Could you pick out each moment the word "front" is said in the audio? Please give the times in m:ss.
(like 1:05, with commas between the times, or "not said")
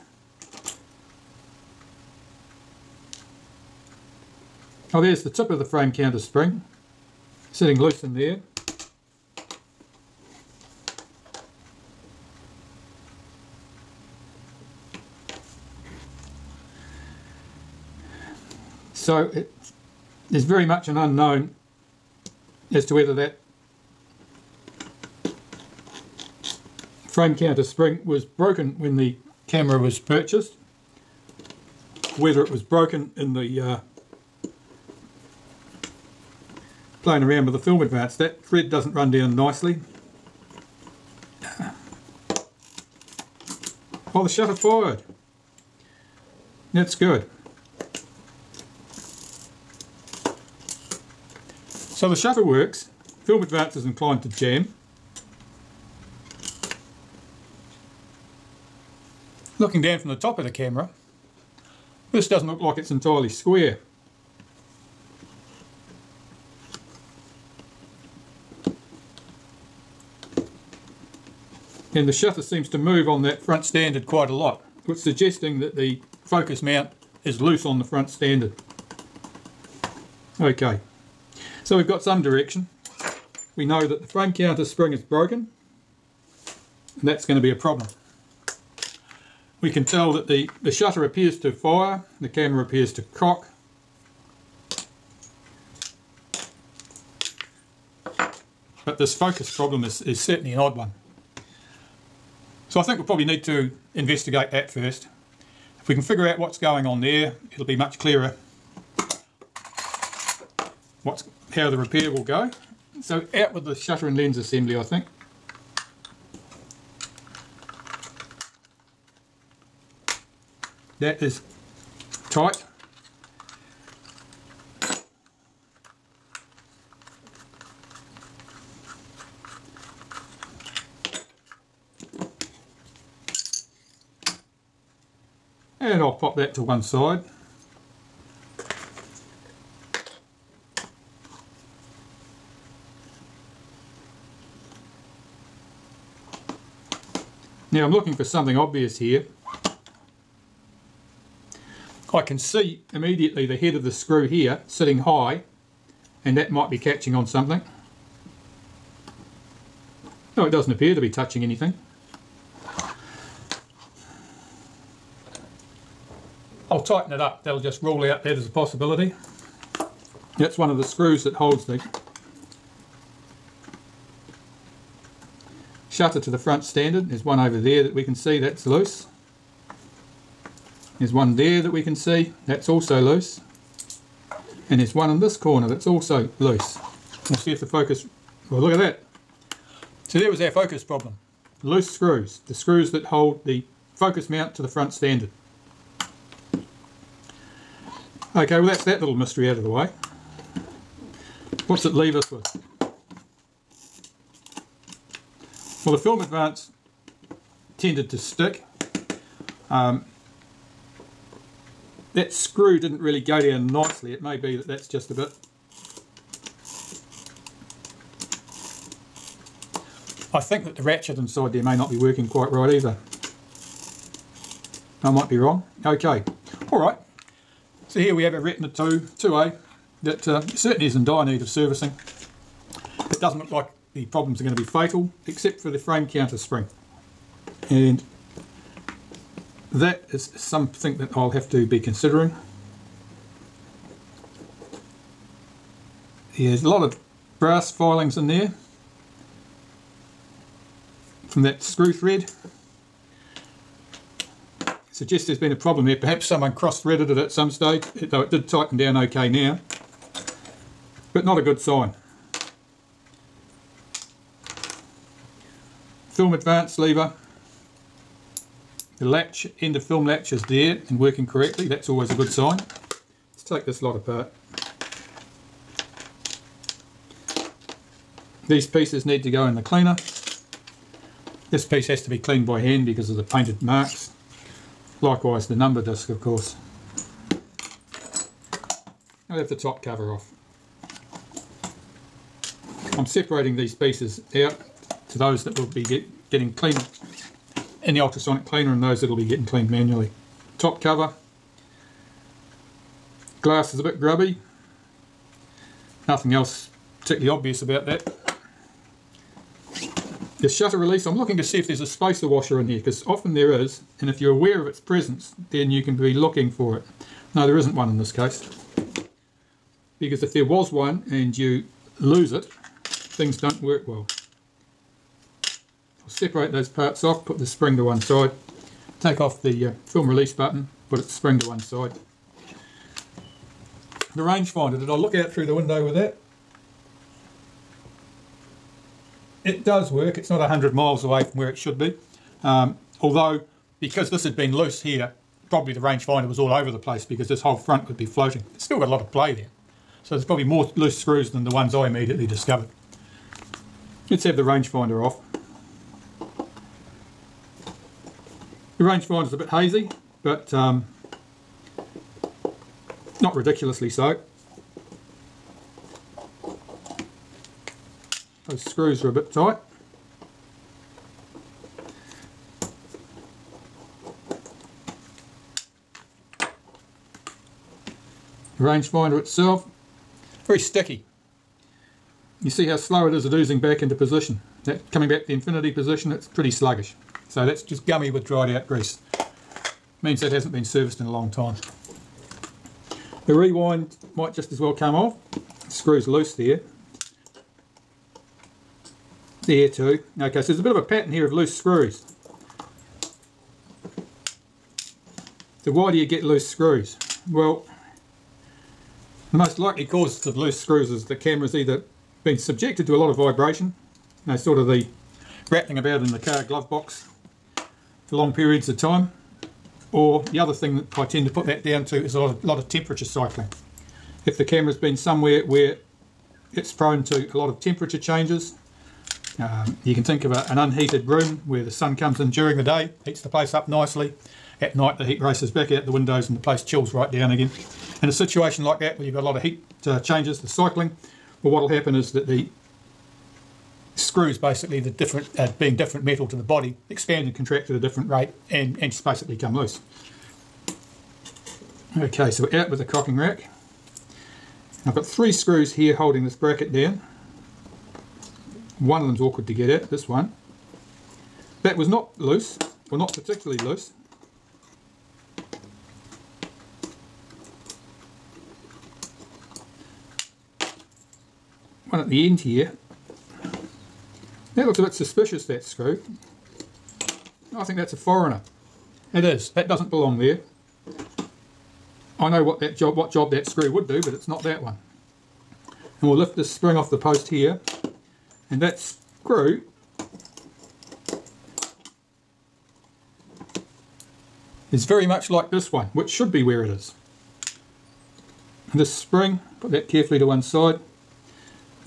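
1:13, 1:17, 2:56, 3:14, 5:47.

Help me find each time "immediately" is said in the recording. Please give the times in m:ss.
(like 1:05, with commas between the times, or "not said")
2:32, 5:51.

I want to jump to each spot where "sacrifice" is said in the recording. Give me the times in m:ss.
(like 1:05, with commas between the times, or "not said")
not said.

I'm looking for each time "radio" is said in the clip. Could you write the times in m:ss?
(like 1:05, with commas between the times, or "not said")
not said.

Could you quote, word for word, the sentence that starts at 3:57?
And that is something that I'll have to be considering.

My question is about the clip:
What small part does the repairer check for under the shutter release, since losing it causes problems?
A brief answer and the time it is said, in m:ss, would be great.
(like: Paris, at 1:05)
spacer washer, at 5:11.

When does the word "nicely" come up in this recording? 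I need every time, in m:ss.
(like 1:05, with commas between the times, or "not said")
0:39, 3:33, 7:13.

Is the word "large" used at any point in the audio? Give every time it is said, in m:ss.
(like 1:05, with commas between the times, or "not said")
not said.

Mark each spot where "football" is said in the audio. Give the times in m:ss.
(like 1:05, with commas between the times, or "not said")
not said.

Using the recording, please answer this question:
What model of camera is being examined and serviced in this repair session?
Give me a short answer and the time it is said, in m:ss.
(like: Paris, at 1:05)
Retina 2A, at 3:48.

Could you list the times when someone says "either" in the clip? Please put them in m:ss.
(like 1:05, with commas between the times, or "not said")
3:42, 6:51.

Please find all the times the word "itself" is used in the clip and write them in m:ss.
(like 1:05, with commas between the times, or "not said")
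6:19.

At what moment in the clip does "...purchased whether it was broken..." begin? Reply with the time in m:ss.
0:29.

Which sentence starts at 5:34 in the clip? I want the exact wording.
The rangefinder, did I look out through the window with that?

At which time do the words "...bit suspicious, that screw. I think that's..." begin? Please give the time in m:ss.
7:54.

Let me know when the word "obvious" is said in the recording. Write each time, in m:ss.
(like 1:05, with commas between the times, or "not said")
2:28, 5:07.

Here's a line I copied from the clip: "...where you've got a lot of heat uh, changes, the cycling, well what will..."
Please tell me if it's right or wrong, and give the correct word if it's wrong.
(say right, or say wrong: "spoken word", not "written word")
right.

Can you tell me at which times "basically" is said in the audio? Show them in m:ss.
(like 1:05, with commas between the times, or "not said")
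7:24, 7:29.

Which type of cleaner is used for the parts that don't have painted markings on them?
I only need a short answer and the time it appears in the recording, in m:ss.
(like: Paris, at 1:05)
ultrasonic cleaner, at 4:58.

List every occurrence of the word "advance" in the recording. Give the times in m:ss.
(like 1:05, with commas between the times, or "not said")
0:37, 0:53, 3:26, 4:26.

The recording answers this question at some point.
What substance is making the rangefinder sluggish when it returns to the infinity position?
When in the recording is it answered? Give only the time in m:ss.
6:28.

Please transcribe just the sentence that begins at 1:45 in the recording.
If we can figure out what's going on there, it'll be much clearer what's, how the repair will go.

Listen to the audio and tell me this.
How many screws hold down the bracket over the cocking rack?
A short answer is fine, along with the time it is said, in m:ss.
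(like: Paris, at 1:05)
3, at 7:35.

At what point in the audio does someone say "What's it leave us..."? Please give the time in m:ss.
3:21.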